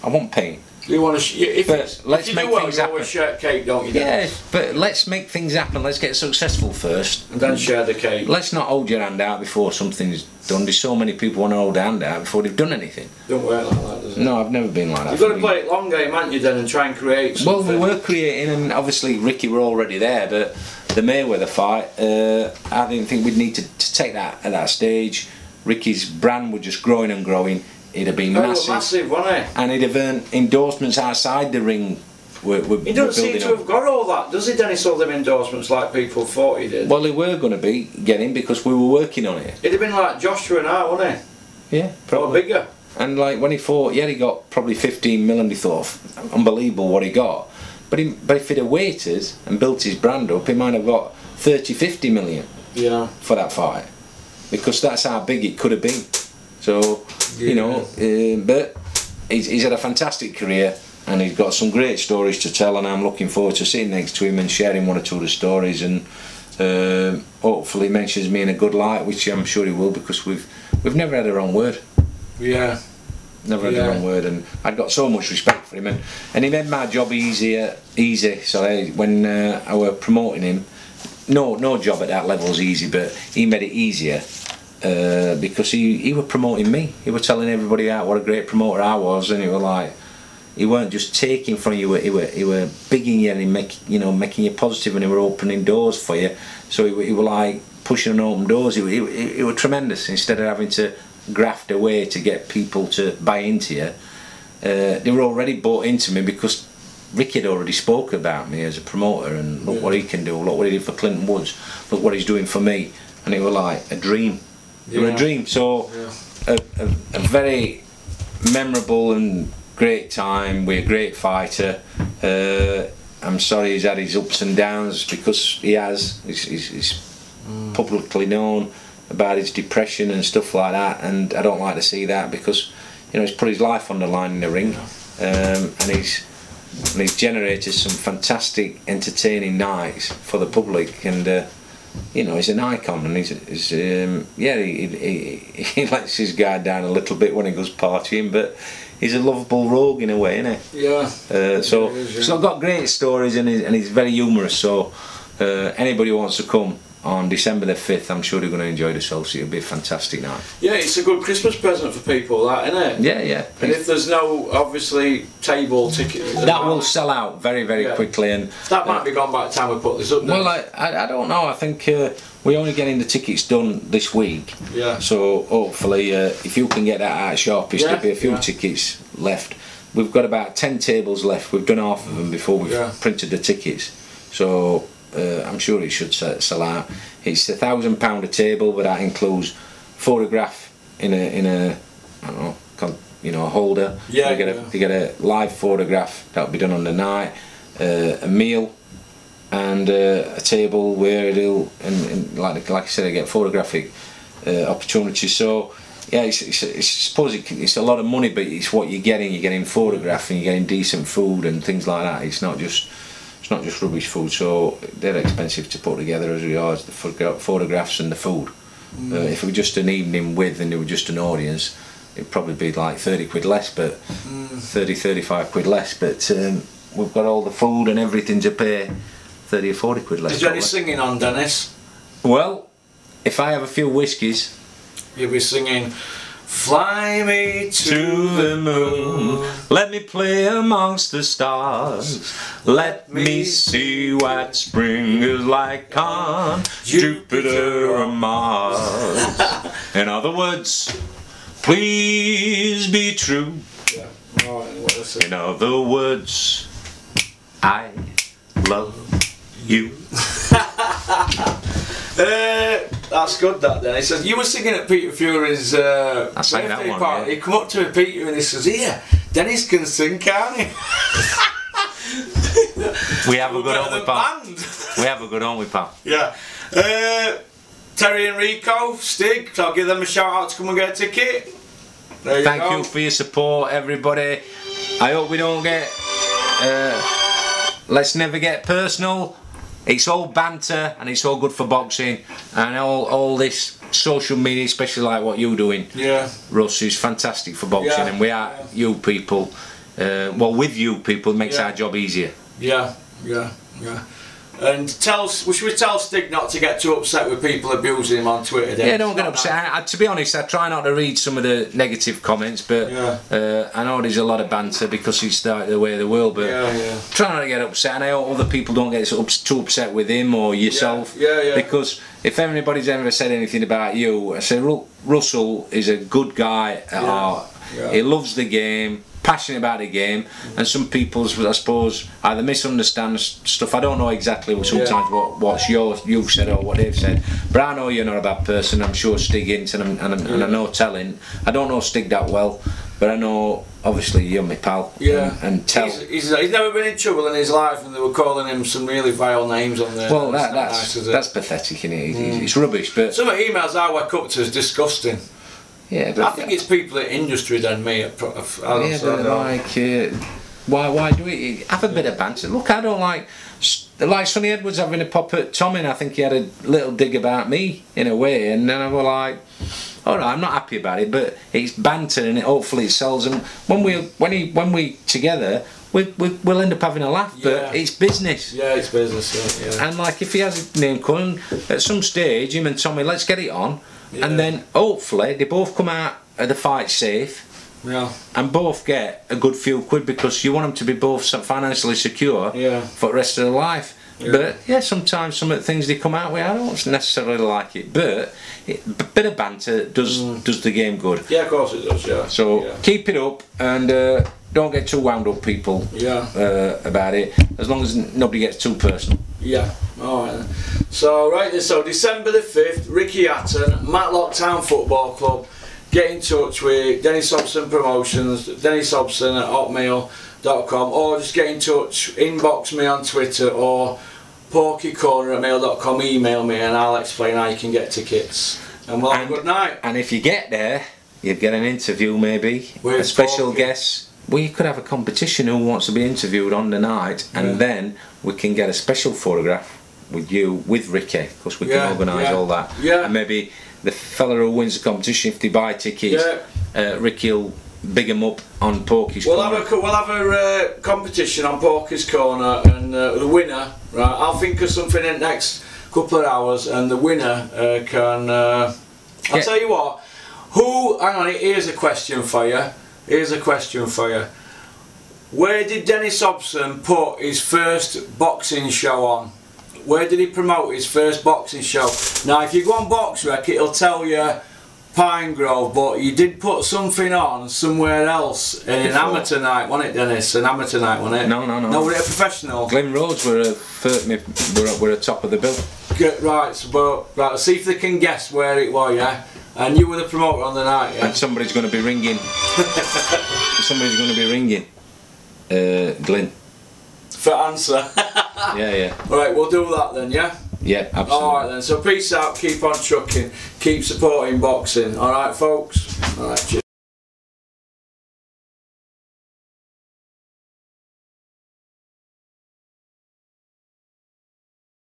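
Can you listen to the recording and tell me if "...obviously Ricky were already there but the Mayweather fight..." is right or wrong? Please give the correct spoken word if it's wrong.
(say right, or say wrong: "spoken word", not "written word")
right.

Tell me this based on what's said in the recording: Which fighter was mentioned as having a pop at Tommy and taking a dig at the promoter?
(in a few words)
Sunny Edwards.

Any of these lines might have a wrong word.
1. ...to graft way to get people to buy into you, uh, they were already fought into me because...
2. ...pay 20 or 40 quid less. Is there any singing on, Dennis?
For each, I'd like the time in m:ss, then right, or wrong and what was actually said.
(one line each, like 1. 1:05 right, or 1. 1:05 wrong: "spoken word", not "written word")
1. 1:40 wrong: "bought", not "fought"
2. 3:48 wrong: "30", not "20".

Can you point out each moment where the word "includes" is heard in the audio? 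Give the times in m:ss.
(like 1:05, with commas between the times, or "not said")
3:09.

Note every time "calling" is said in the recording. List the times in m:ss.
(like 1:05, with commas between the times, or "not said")
5:48, 6:21.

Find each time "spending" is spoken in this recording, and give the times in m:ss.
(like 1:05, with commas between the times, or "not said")
not said.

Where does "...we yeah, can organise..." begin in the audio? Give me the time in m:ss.
7:21.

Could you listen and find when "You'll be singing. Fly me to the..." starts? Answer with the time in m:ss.
3:55.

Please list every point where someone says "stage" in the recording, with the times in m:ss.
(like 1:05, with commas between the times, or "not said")
0:24, 6:22.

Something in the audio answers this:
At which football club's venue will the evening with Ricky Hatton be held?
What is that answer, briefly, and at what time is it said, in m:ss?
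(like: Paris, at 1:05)
Matlock Town Football Club, at 6:53.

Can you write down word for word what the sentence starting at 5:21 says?
Because if anybody's ever said anything about you, I say Russell is a good guy.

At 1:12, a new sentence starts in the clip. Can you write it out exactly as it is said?
Yeah never had the wrong word.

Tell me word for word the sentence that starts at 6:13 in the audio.
And when we when he when we together, we, we, will end up having a laugh, yeah.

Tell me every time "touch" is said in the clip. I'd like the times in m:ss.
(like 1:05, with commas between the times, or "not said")
6:56, 7:01.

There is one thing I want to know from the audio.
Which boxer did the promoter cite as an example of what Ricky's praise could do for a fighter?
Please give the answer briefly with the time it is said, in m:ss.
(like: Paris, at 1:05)
Clinton Woods, at 1:50.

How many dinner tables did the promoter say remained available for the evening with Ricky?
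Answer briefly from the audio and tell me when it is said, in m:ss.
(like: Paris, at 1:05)
10, at 3:00.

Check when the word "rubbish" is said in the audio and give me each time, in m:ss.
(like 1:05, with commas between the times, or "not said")
3:33, 5:52.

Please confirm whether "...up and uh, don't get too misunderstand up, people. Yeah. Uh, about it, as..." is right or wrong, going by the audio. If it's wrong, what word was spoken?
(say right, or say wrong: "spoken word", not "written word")
wrong: "wound", not "misunderstand".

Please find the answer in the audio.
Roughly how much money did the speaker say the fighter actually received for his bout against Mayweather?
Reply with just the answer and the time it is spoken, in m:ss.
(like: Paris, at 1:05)
15 million, at 0:44.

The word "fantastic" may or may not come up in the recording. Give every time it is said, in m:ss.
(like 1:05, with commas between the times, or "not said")
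0:59, 2:17, 2:39, 4:56.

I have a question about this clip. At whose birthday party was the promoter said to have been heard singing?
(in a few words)
Peter Fury.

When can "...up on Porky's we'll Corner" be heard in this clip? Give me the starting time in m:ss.
7:28.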